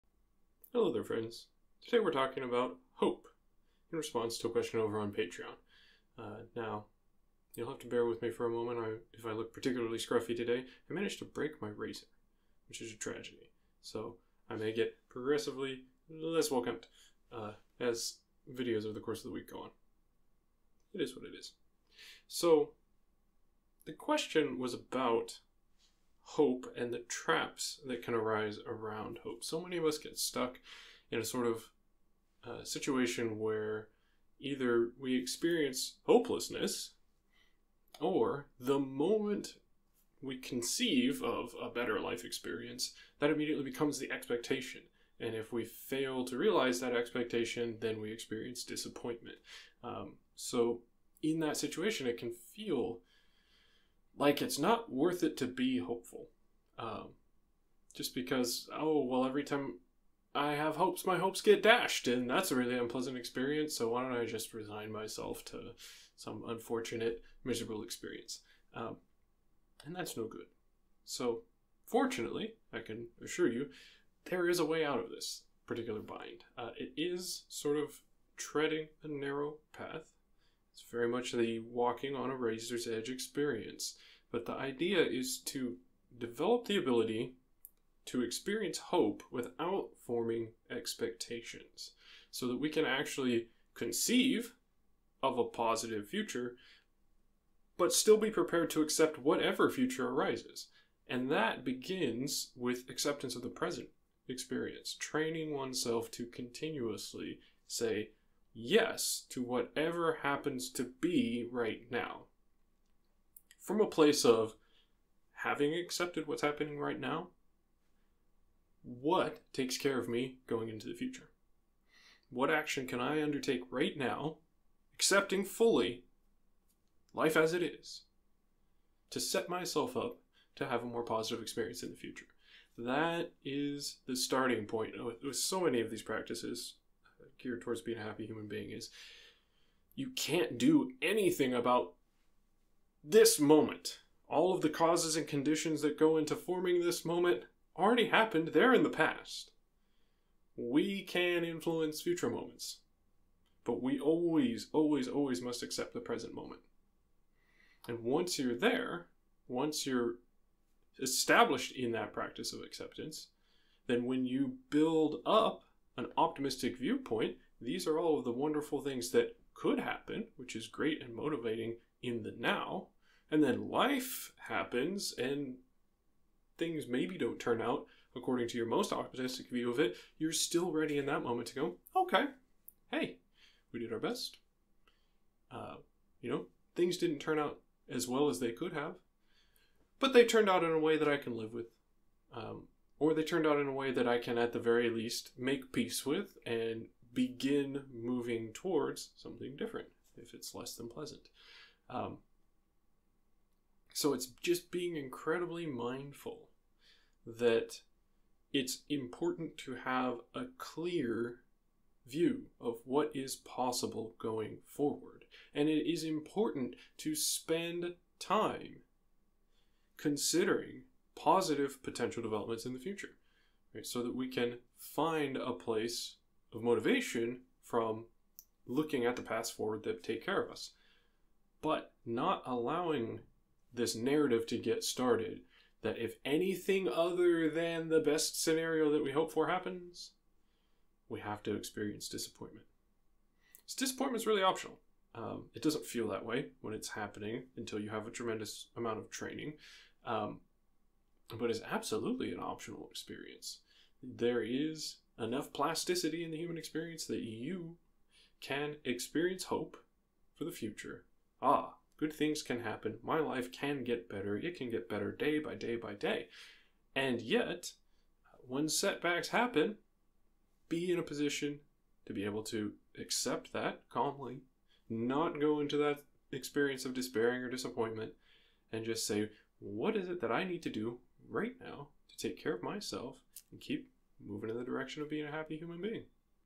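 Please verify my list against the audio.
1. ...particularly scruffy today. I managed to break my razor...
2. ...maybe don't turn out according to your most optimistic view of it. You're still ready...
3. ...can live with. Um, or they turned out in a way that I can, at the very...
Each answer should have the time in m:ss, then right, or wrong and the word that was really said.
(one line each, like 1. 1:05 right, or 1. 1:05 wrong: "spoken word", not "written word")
1. 0:09 right
2. 2:56 right
3. 3:11 right.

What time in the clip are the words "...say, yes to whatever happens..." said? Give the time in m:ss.
1:47.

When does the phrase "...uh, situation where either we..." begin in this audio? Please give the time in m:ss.
0:32.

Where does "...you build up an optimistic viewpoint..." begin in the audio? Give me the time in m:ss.
2:44.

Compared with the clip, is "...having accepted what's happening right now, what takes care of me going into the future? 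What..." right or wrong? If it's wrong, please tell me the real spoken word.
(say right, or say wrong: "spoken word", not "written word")
right.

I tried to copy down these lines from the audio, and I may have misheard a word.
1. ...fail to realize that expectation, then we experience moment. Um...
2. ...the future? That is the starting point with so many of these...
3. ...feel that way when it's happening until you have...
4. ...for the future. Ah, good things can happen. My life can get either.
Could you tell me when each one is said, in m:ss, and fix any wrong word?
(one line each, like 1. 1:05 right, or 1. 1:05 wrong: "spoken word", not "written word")
1. 0:45 wrong: "disappointment", not "moment"
2. 2:11 right
3. 4:05 right
4. 4:20 wrong: "better", not "either".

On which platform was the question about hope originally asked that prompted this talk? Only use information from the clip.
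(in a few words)
Patreon.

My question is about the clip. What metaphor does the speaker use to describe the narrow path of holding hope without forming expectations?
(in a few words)
walking on a razor's edge.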